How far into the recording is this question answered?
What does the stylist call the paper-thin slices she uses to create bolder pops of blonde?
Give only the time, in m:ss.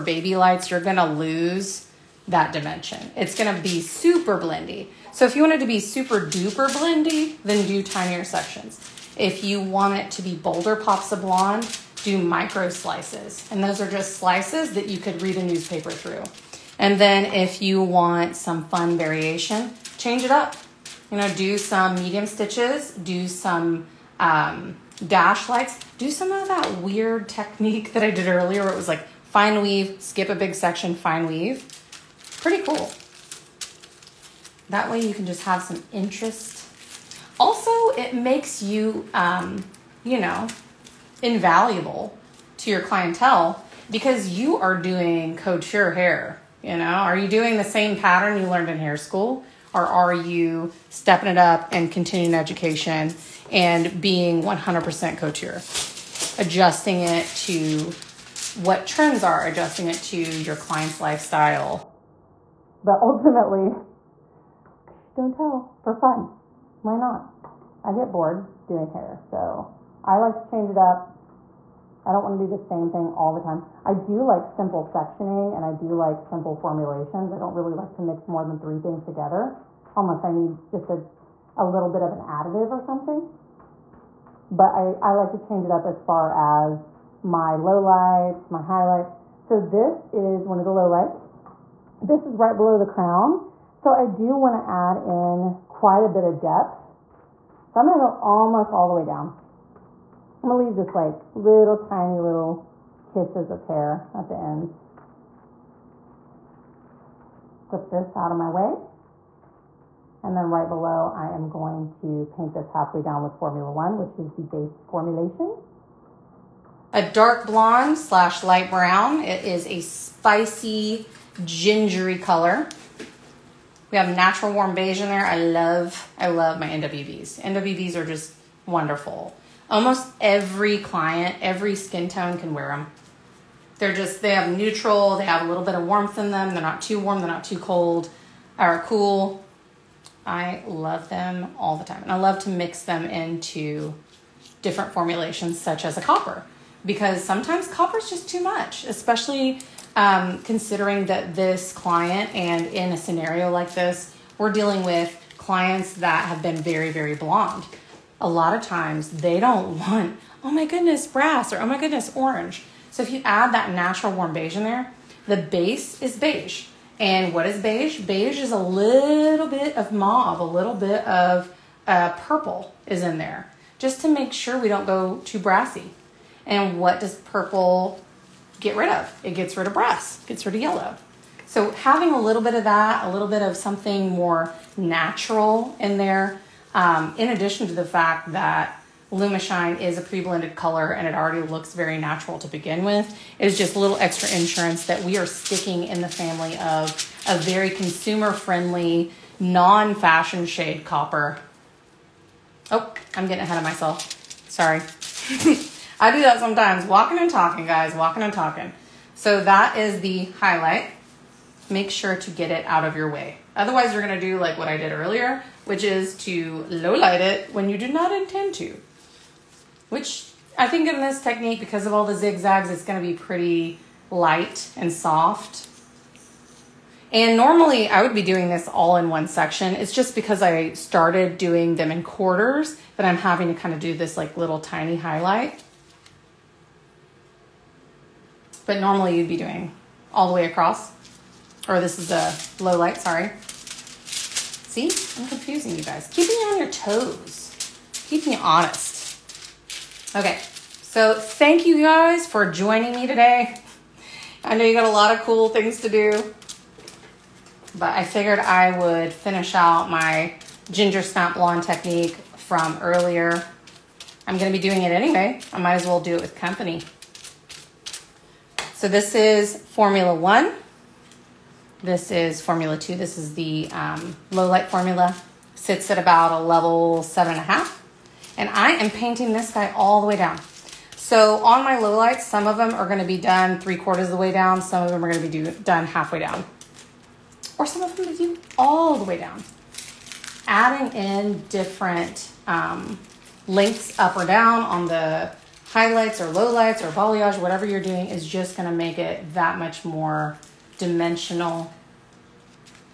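0:12.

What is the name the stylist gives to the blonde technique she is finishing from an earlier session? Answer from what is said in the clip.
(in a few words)
ginger snap blonde.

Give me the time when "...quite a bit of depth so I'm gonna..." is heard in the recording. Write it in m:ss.
1:35.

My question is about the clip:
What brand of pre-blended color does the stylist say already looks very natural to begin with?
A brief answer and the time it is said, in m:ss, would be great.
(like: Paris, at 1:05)
Lumishine, at 3:09.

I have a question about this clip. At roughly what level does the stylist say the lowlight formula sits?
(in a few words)
7.5.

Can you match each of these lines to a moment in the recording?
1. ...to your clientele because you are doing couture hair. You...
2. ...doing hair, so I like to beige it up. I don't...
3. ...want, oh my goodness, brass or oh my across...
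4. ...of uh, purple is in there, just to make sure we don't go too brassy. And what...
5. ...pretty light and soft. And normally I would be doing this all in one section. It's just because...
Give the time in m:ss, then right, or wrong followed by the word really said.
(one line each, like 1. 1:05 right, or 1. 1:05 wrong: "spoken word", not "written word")
1. 0:42 right
2. 1:08 wrong: "change", not "beige"
3. 2:39 wrong: "goodness", not "across"
4. 2:51 right
5. 3:43 right.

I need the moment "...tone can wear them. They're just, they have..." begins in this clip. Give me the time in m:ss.
2:12.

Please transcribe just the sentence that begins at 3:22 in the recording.
Oh, I'm getting ahead of myself.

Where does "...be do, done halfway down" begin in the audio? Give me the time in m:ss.
4:45.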